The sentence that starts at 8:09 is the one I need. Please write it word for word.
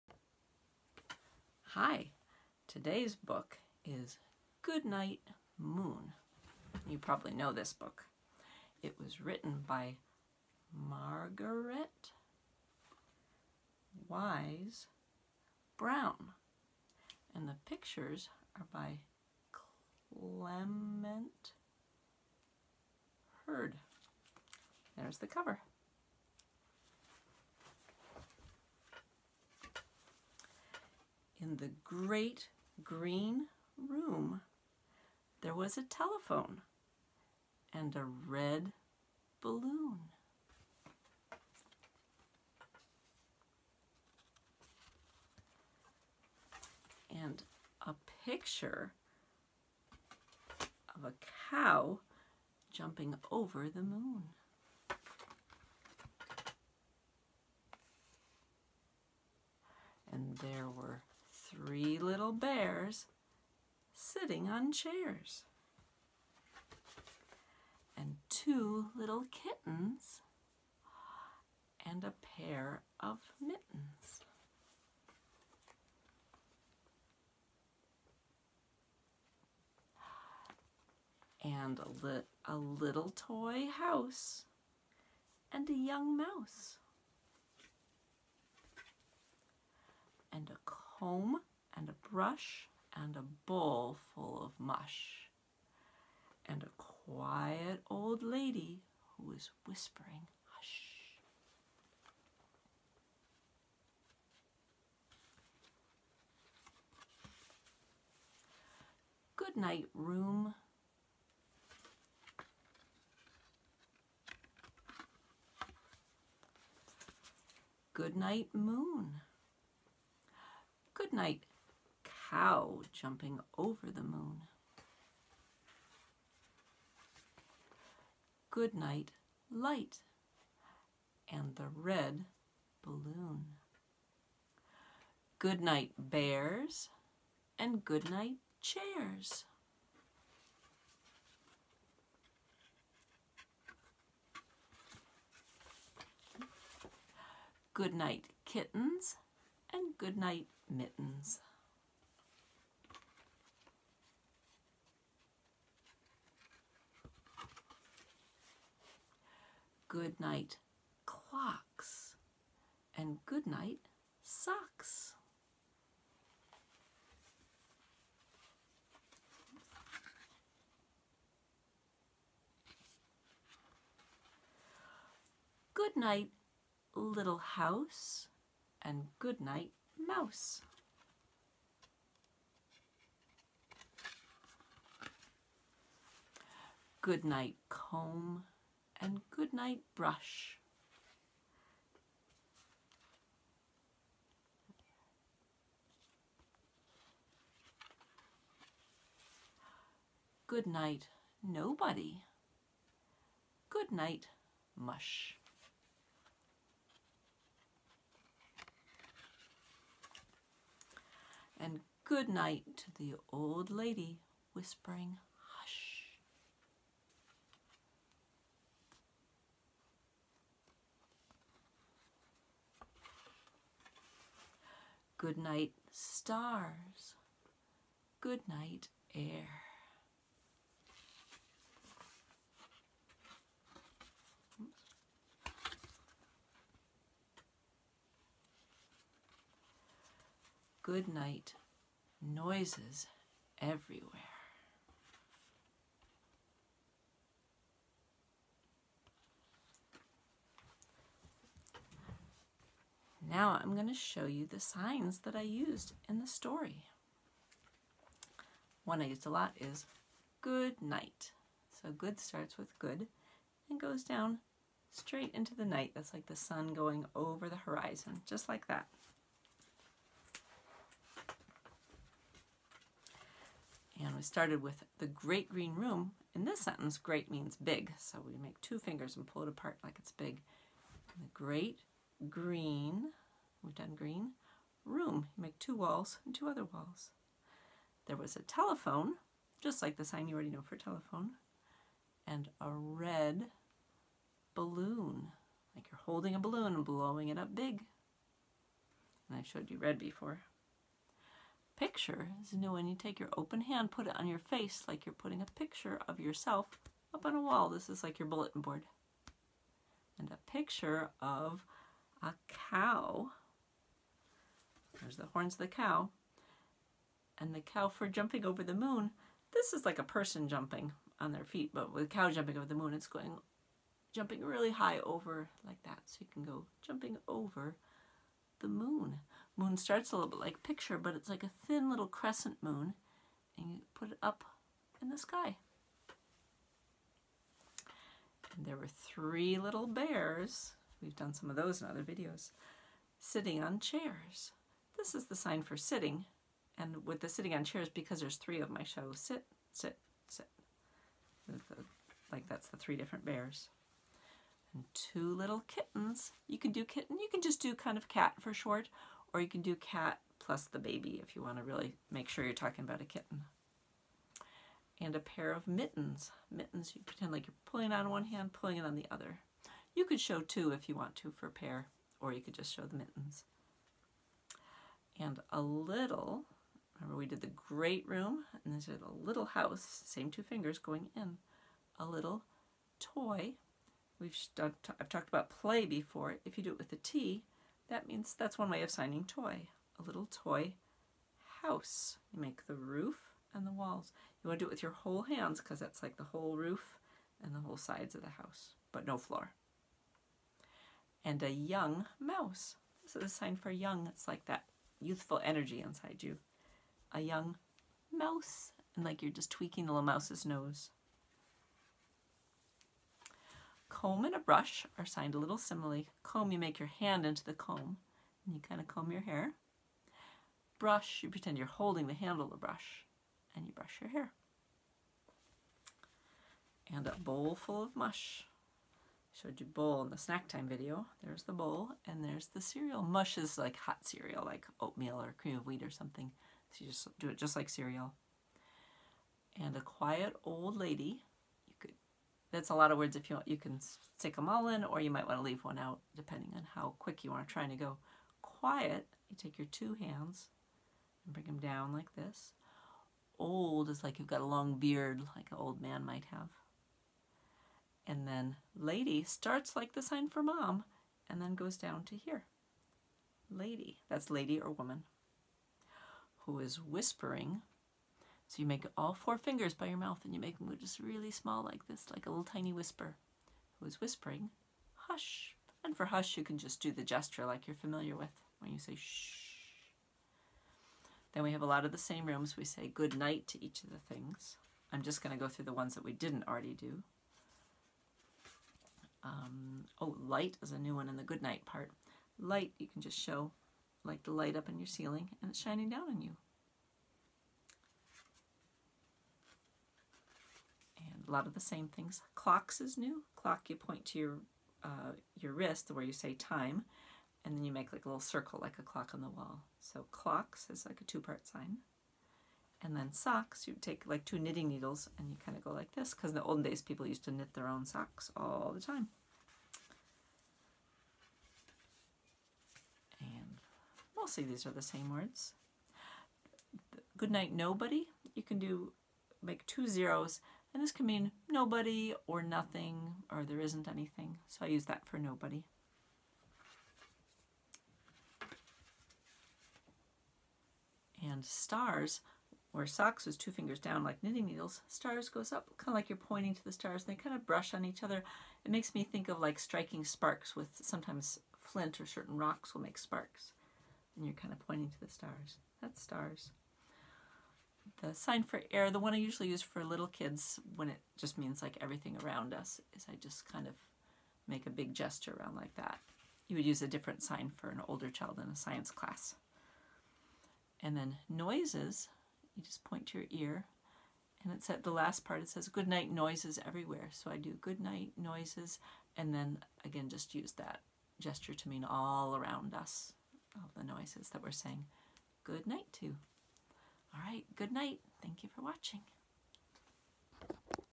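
Um, oh, light is a new one in the good night part.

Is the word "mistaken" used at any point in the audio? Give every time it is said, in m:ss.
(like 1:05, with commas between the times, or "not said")
not said.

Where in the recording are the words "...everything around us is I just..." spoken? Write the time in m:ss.
9:21.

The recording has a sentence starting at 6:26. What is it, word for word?
If you do it with a T, that means that's one way of signing toy, a little toy house.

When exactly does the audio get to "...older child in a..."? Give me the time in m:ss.
9:27.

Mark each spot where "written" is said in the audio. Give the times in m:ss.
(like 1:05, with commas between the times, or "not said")
0:09.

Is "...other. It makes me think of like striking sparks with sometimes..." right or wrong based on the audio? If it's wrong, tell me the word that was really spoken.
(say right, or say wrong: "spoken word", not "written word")
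right.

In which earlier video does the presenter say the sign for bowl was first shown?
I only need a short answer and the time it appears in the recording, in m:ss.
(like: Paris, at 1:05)
snack time video, at 7:10.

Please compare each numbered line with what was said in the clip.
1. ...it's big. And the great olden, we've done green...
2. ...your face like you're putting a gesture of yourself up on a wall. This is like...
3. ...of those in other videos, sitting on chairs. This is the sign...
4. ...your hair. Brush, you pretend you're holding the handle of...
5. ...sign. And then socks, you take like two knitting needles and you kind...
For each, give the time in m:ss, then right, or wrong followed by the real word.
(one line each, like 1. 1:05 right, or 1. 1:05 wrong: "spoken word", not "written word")
1. 4:39 wrong: "green", not "olden"
2. 5:04 wrong: "picture", not "gesture"
3. 5:41 right
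4. 6:59 right
5. 8:31 right.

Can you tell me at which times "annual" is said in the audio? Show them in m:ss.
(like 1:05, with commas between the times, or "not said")
not said.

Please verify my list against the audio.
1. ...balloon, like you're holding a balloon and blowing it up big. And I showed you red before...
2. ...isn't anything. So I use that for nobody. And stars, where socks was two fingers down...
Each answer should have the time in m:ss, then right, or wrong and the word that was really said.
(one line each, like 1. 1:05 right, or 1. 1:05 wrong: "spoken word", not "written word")
1. 4:54 right
2. 8:53 right.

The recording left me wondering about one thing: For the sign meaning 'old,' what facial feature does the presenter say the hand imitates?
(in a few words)
long beard.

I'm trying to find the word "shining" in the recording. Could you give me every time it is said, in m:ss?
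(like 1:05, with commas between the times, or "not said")
8:15.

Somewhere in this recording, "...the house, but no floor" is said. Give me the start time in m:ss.
6:38.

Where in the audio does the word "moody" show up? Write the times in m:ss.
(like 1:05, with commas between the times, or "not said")
not said.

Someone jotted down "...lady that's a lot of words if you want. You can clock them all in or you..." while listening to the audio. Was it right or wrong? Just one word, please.
wrong.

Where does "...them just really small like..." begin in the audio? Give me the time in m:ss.
7:50.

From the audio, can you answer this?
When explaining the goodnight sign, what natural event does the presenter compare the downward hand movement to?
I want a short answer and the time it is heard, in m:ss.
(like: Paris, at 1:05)
sun going over the horizon, at 4:26.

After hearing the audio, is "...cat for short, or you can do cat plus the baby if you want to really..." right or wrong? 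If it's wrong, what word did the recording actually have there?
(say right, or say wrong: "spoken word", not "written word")
right.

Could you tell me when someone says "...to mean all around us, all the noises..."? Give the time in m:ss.
9:41.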